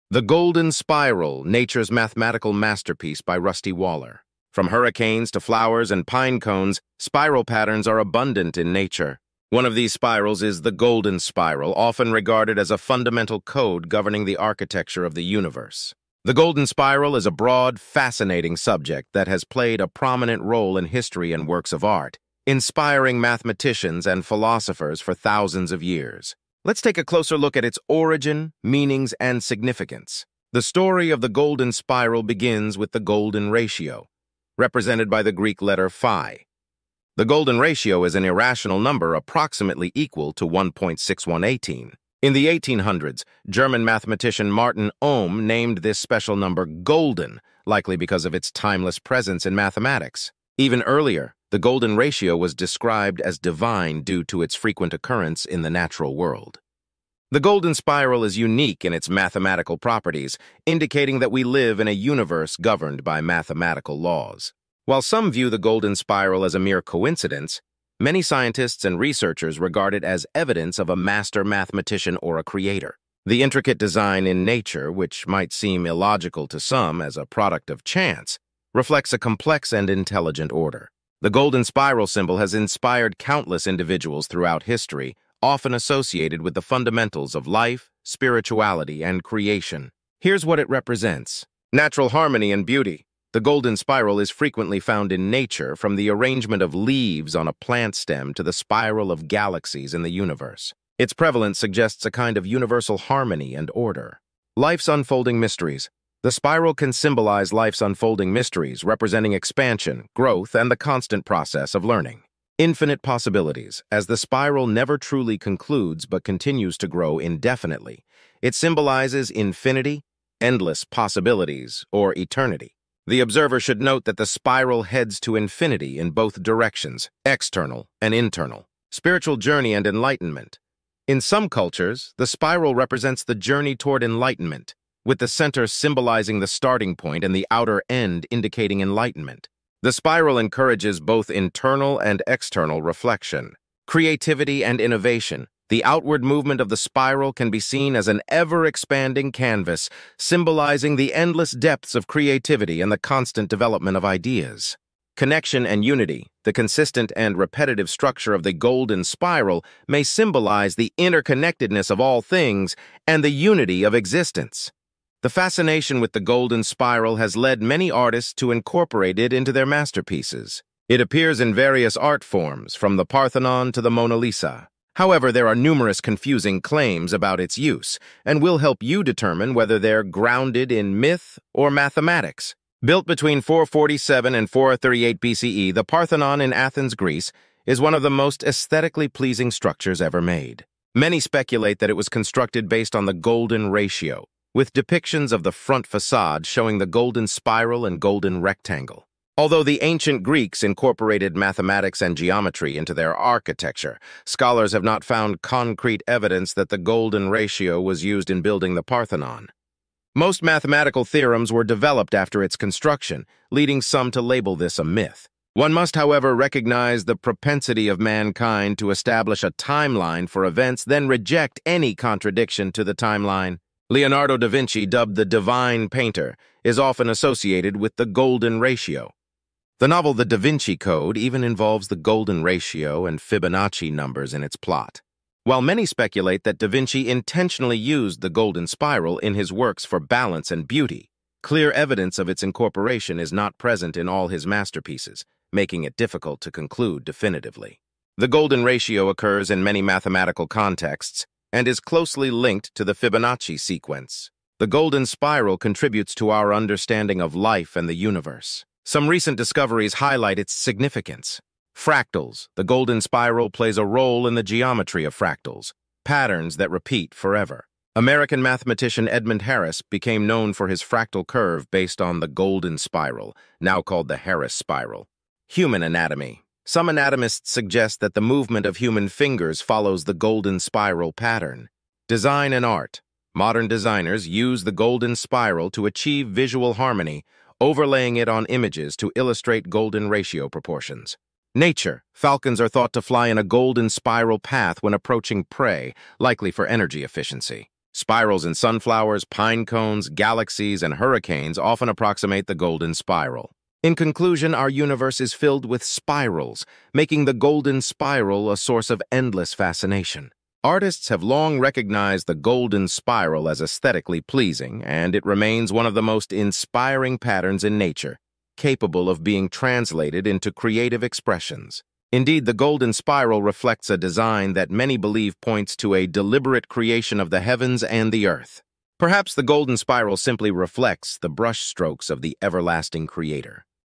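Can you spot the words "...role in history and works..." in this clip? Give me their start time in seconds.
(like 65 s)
20 s.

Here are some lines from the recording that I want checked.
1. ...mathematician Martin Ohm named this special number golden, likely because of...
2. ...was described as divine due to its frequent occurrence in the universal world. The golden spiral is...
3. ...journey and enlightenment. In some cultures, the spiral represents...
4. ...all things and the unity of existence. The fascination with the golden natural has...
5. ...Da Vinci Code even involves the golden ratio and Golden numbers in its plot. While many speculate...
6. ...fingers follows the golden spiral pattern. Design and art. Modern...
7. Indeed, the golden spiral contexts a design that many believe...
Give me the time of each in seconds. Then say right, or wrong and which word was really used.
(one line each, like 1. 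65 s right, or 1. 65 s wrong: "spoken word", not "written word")
1. 43 s right
2. 52 s wrong: "natural", not "universal"
3. 129 s right
4. 162 s wrong: "spiral", not "natural"
5. 230 s wrong: "Fibonacci", not "Golden"
6. 279 s right
7. 322 s wrong: "reflects", not "contexts".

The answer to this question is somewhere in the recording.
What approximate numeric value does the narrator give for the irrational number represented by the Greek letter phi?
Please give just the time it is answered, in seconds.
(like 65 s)
40 s.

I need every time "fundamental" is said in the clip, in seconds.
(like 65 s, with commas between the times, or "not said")
12 s, 86 s.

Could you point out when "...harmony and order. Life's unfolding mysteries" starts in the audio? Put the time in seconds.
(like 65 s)
102 s.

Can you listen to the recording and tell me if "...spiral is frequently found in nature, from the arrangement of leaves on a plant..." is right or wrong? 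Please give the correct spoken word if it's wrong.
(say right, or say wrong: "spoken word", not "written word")
right.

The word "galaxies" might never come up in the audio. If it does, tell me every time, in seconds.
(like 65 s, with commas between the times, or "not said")
99 s, 300 s.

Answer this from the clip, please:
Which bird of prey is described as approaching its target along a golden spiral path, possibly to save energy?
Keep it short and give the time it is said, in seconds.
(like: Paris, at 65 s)
Falcons, at 292 s.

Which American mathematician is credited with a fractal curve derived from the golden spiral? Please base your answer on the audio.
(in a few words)
Edmund Harris.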